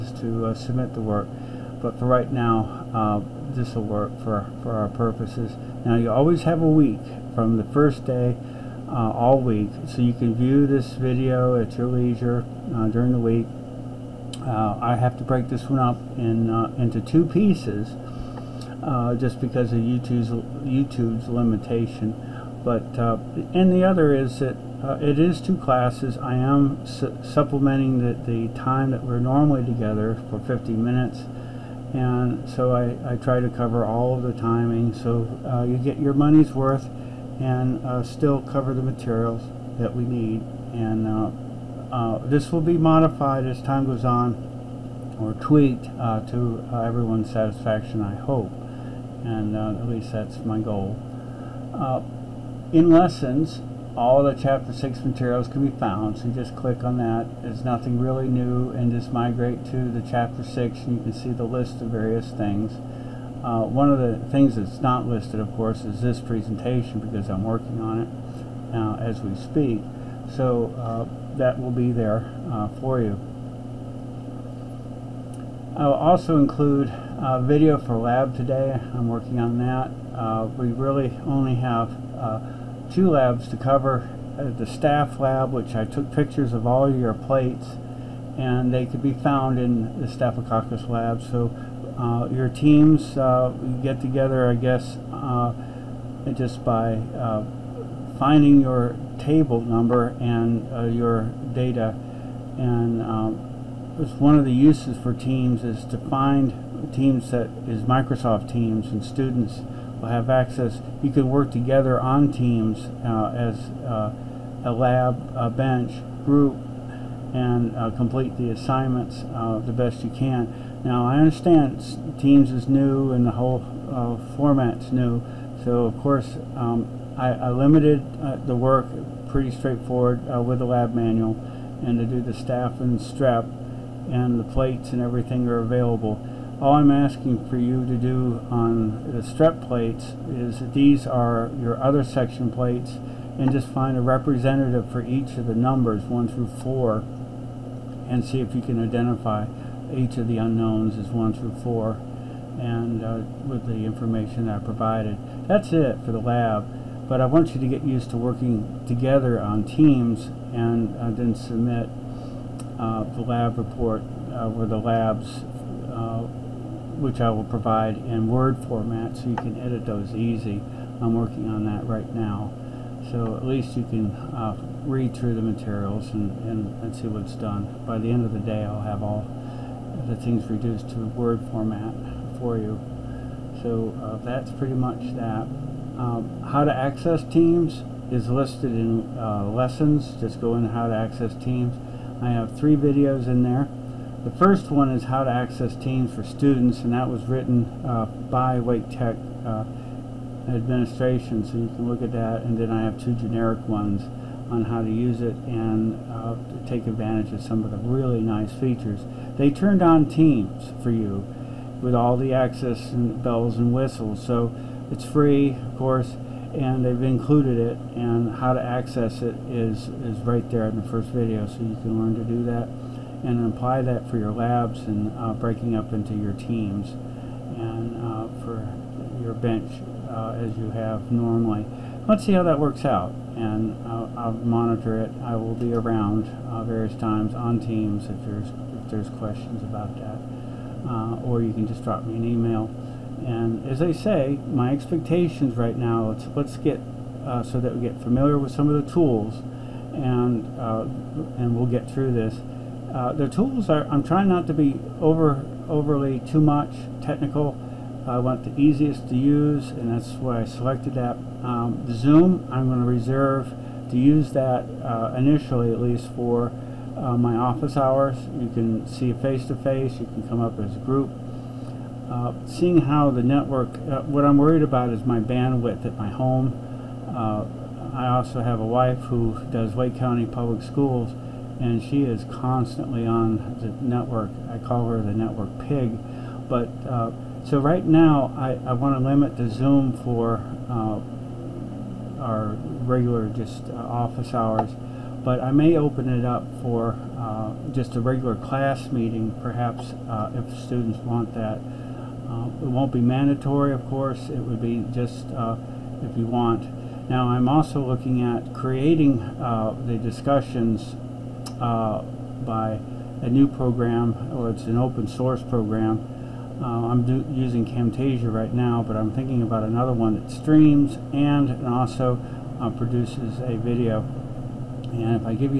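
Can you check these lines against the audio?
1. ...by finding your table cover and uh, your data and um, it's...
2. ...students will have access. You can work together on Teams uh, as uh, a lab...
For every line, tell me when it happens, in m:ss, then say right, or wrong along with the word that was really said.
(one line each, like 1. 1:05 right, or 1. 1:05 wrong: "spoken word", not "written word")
1. 1:36 wrong: "number", not "cover"
2. 1:49 right.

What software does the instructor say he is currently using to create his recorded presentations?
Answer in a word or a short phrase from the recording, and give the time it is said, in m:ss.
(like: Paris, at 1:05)
Camtasia, at 5:17.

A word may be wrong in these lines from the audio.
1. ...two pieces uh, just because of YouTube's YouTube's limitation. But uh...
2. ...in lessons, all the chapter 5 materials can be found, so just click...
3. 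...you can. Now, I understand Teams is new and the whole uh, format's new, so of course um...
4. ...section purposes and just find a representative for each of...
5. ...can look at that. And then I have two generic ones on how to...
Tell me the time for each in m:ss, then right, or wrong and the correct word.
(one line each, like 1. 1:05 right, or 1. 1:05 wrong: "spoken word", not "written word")
1. 0:17 right
2. 0:52 wrong: "6", not "5"
3. 2:00 right
4. 2:22 wrong: "plates", not "purposes"
5. 3:21 right.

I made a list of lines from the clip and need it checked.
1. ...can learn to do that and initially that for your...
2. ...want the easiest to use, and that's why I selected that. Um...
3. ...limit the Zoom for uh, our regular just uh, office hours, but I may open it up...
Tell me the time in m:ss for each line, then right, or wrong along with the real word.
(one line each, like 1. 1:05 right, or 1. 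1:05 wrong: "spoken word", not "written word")
1. 3:41 wrong: "apply", not "initially"
2. 4:18 right
3. 4:49 right.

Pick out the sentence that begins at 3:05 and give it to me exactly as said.
Um, how to access Teams is listed in uh, lessons.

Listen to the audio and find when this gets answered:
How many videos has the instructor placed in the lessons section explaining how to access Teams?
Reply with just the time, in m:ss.
3:12.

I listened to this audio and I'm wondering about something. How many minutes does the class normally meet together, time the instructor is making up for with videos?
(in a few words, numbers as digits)
50.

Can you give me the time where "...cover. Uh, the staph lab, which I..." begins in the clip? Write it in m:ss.
1:23.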